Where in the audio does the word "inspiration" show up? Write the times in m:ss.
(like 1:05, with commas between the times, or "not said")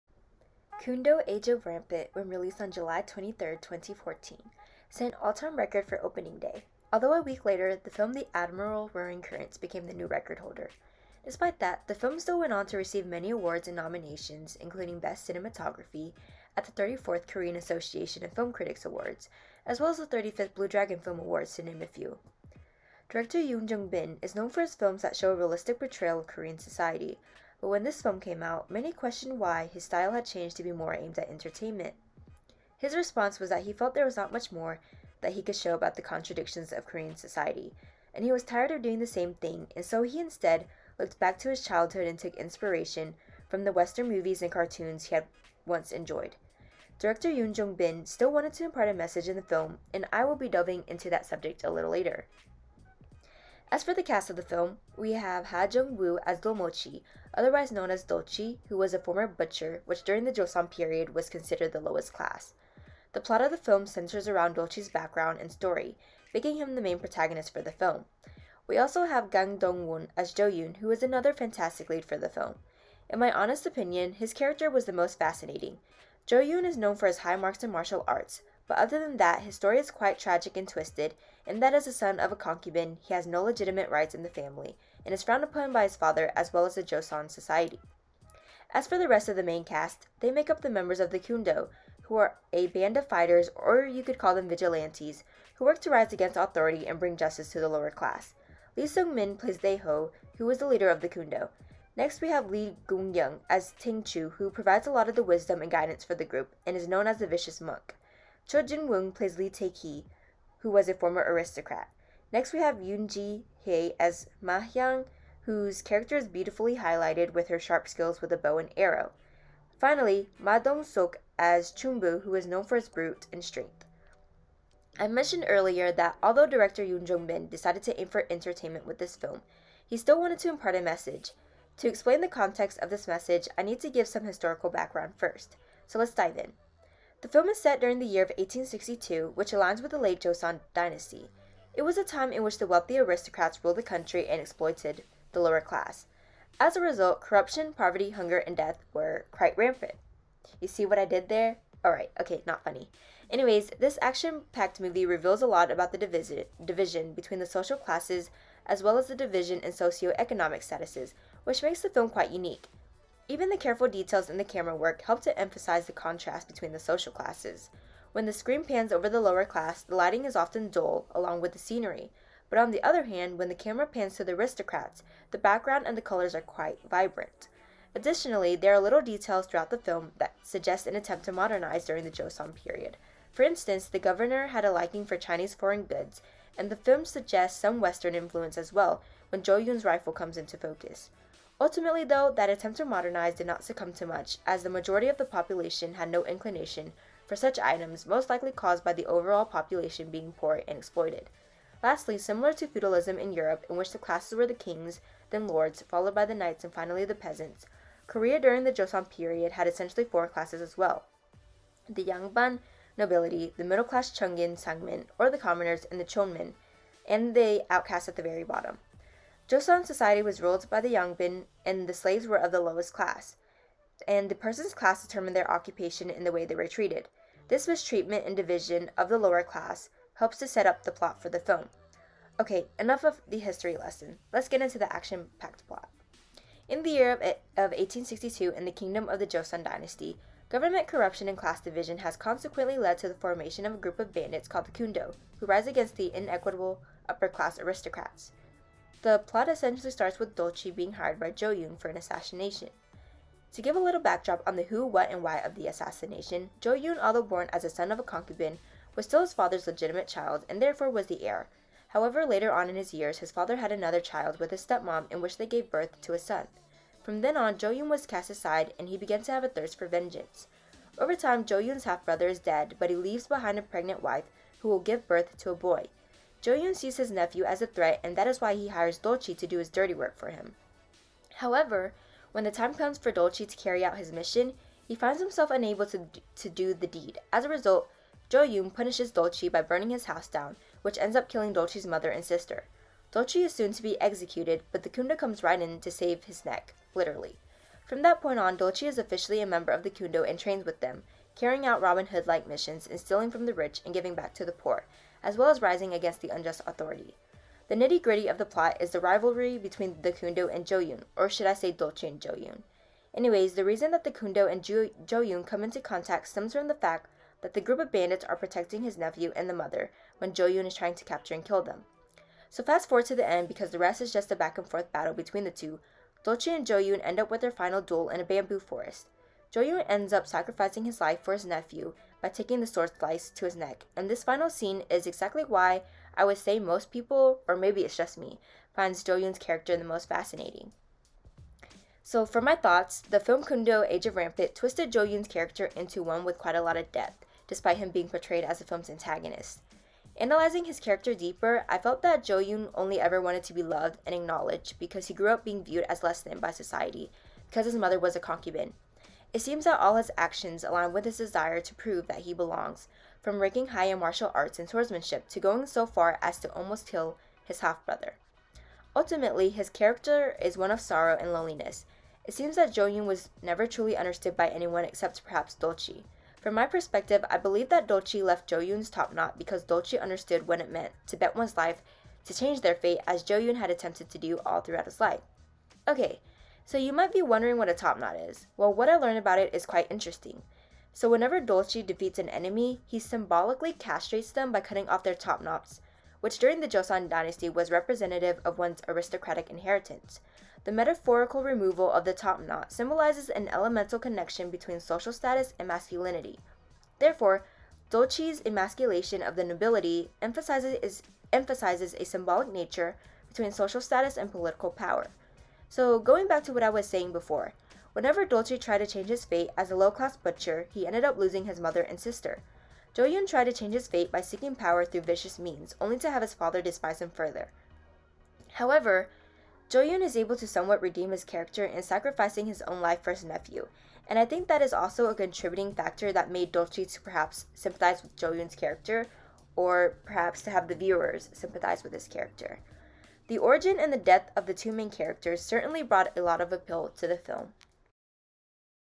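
0:42.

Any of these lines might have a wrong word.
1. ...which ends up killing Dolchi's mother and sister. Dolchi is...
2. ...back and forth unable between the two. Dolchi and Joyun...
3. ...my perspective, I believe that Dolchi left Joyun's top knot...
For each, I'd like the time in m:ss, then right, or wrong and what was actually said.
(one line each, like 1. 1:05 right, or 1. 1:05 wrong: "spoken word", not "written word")
1. 4:50 right
2. 5:24 wrong: "battle", not "unable"
3. 6:16 right.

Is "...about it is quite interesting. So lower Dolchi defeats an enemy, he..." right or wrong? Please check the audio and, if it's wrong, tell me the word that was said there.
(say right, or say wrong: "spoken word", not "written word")
wrong: "whenever", not "lower".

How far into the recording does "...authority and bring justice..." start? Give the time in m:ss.
1:36.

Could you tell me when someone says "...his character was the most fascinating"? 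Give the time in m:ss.
1:14.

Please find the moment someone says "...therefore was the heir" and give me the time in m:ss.
4:20.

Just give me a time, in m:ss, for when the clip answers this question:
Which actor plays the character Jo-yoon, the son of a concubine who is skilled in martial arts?
1:09.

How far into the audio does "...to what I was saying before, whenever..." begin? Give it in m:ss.
6:56.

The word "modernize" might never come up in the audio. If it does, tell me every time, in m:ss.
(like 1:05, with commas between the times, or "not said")
3:01, 3:12.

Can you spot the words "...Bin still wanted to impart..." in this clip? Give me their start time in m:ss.
0:47.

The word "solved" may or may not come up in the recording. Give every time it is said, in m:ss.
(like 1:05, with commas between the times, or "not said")
not said.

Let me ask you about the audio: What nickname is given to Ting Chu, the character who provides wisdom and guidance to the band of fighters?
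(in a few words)
the Vicious Monk.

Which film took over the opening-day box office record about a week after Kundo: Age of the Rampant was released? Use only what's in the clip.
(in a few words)
The Admiral Roaring Currents.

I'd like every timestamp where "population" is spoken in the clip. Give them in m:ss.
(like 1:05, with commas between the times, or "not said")
3:15, 3:19.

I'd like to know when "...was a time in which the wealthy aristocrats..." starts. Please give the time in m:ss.
2:21.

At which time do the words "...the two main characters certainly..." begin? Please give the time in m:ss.
7:24.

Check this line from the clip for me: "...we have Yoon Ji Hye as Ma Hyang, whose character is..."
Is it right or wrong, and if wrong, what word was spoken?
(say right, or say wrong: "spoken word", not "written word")
right.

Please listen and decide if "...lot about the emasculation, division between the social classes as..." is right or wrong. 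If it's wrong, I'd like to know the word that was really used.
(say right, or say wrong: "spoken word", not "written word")
wrong: "division", not "emasculation".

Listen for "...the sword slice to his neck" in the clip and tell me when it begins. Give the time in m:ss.
5:32.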